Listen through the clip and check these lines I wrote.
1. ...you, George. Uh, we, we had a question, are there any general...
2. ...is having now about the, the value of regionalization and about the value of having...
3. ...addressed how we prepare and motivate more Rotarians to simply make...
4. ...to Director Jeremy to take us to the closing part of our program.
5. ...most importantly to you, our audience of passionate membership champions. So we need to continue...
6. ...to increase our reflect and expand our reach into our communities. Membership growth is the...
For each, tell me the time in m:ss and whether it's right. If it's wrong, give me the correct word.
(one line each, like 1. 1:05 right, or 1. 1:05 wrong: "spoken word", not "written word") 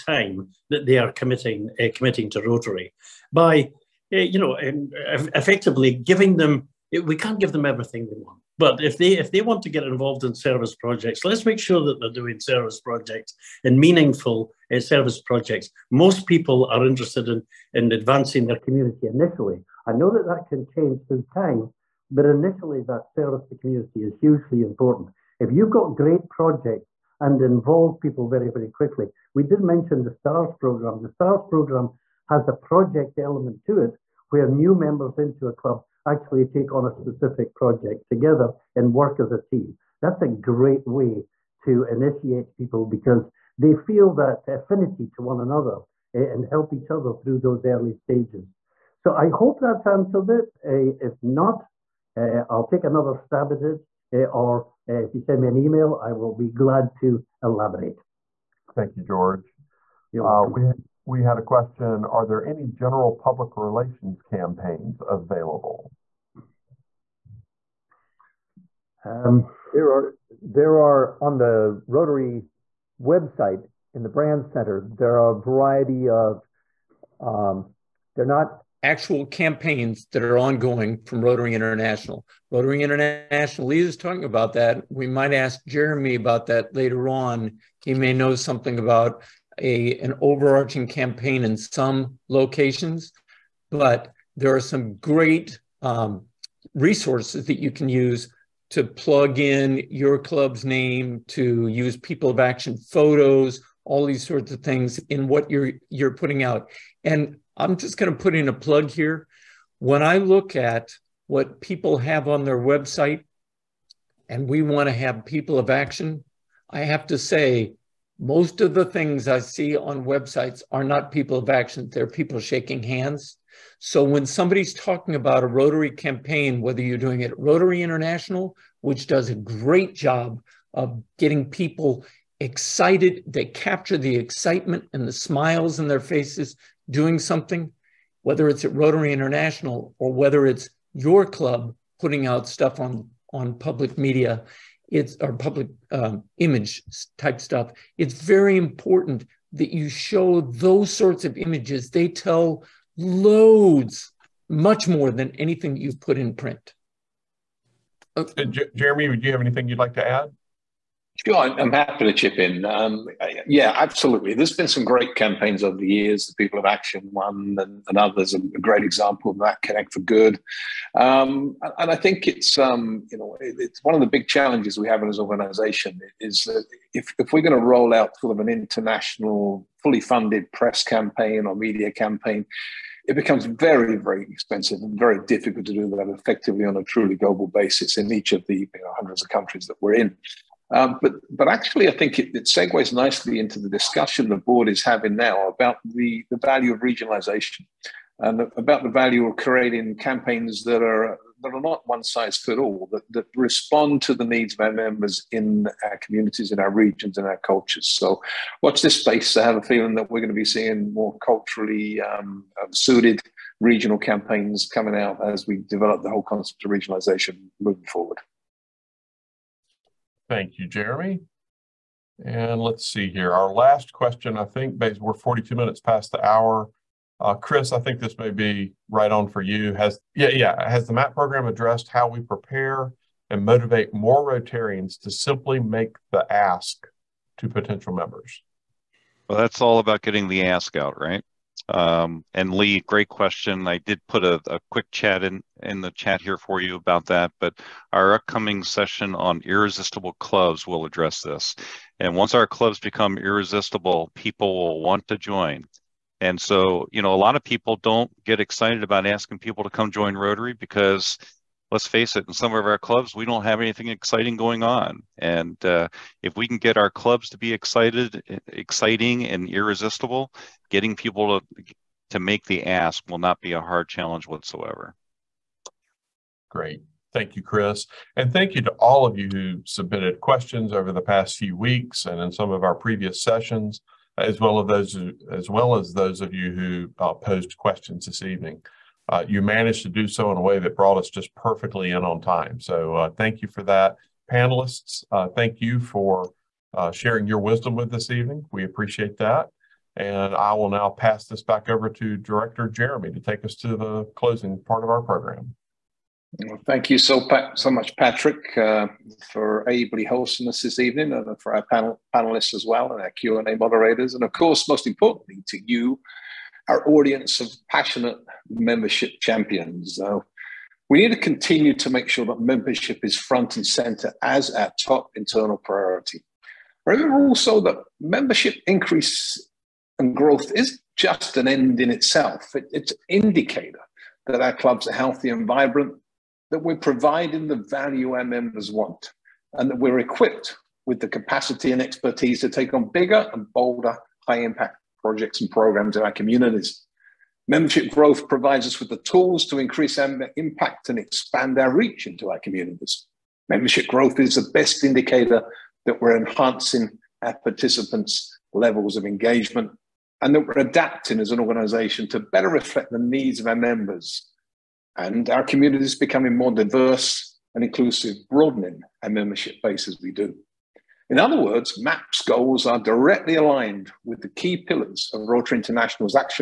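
1. 0:58 right
2. 3:14 wrong: "creating", not "having"
3. 3:51 right
4. 5:01 right
5. 5:14 right
6. 5:49 wrong: "impact", not "reflect".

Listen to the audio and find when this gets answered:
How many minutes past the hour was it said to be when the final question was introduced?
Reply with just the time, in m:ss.
3:45.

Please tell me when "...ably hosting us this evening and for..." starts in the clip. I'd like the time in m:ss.
5:09.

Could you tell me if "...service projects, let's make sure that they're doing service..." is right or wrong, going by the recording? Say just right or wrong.
right.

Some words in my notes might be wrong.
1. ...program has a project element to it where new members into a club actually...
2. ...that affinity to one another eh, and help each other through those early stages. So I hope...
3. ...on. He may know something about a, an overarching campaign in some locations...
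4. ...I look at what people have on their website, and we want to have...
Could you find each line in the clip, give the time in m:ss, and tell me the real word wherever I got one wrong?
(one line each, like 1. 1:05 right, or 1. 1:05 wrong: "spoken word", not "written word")
1. 0:31 right
2. 0:44 right
3. 1:27 right
4. 1:50 right.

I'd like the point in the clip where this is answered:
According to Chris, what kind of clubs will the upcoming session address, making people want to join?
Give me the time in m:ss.
4:09.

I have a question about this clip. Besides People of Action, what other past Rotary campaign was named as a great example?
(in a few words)
Connect for Good.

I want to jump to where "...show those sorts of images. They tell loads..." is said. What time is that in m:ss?
2:29.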